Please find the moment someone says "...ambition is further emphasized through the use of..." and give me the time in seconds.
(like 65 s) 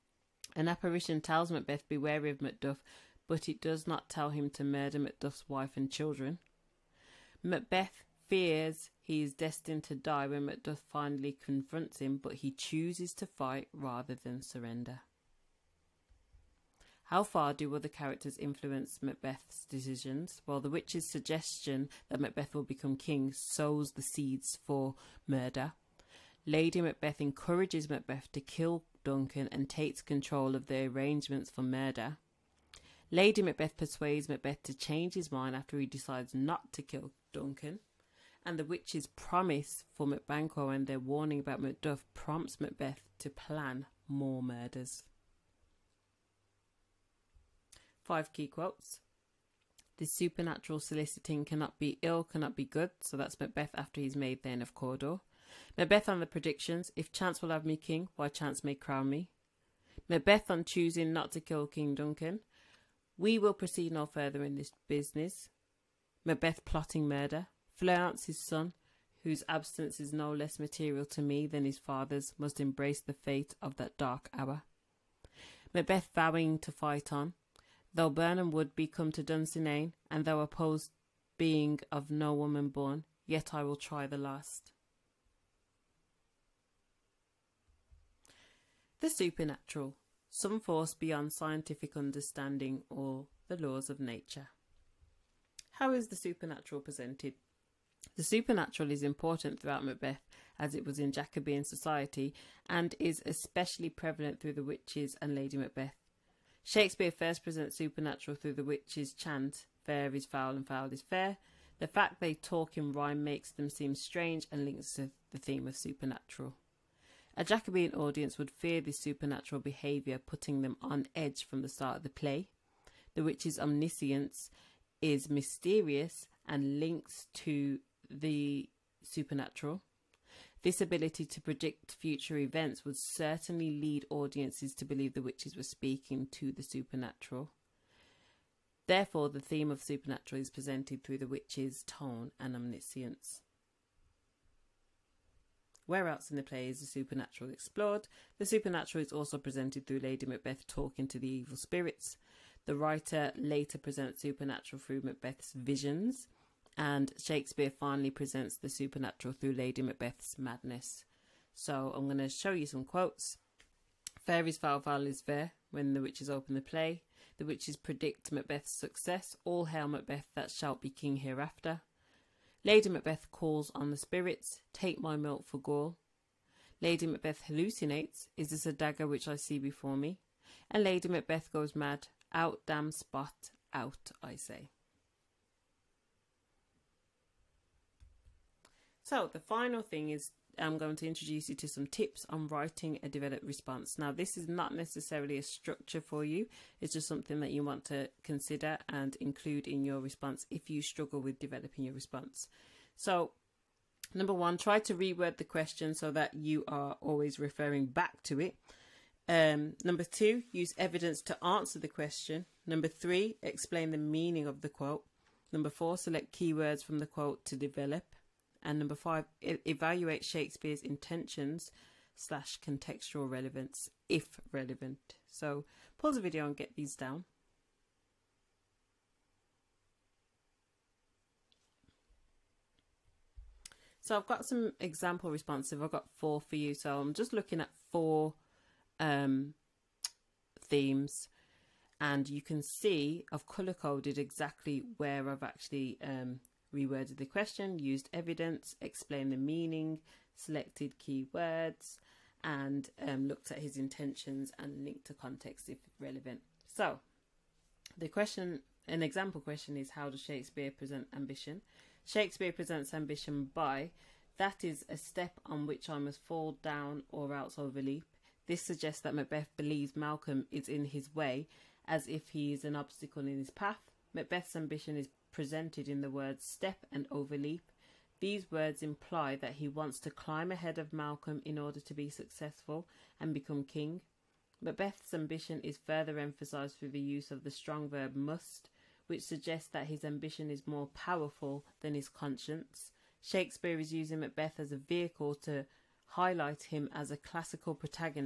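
285 s.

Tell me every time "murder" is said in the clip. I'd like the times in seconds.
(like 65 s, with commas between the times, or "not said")
4 s, 25 s, 31 s, 44 s, 67 s.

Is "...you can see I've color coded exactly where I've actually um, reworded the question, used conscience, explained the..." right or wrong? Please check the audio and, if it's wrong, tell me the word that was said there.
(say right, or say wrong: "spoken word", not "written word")
wrong: "evidence", not "conscience".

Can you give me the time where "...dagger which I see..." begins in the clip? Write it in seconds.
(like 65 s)
178 s.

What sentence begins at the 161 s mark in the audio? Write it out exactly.
So I'm going to show you some quotes.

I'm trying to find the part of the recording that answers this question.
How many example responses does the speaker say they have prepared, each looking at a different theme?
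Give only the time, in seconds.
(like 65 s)
235 s.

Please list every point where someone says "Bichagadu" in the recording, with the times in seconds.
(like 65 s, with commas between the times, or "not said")
not said.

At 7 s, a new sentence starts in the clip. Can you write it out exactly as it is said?
Macbeth fears he is destined to die when Macduff finally confronts him, but he chooses to fight rather than surrender.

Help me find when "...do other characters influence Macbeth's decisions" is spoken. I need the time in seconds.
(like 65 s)
17 s.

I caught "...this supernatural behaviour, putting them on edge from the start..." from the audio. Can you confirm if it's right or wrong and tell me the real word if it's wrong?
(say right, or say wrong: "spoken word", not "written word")
right.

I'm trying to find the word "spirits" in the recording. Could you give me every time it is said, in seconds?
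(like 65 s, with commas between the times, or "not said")
151 s, 173 s.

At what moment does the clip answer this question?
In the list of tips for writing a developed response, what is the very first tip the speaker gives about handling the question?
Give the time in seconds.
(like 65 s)
204 s.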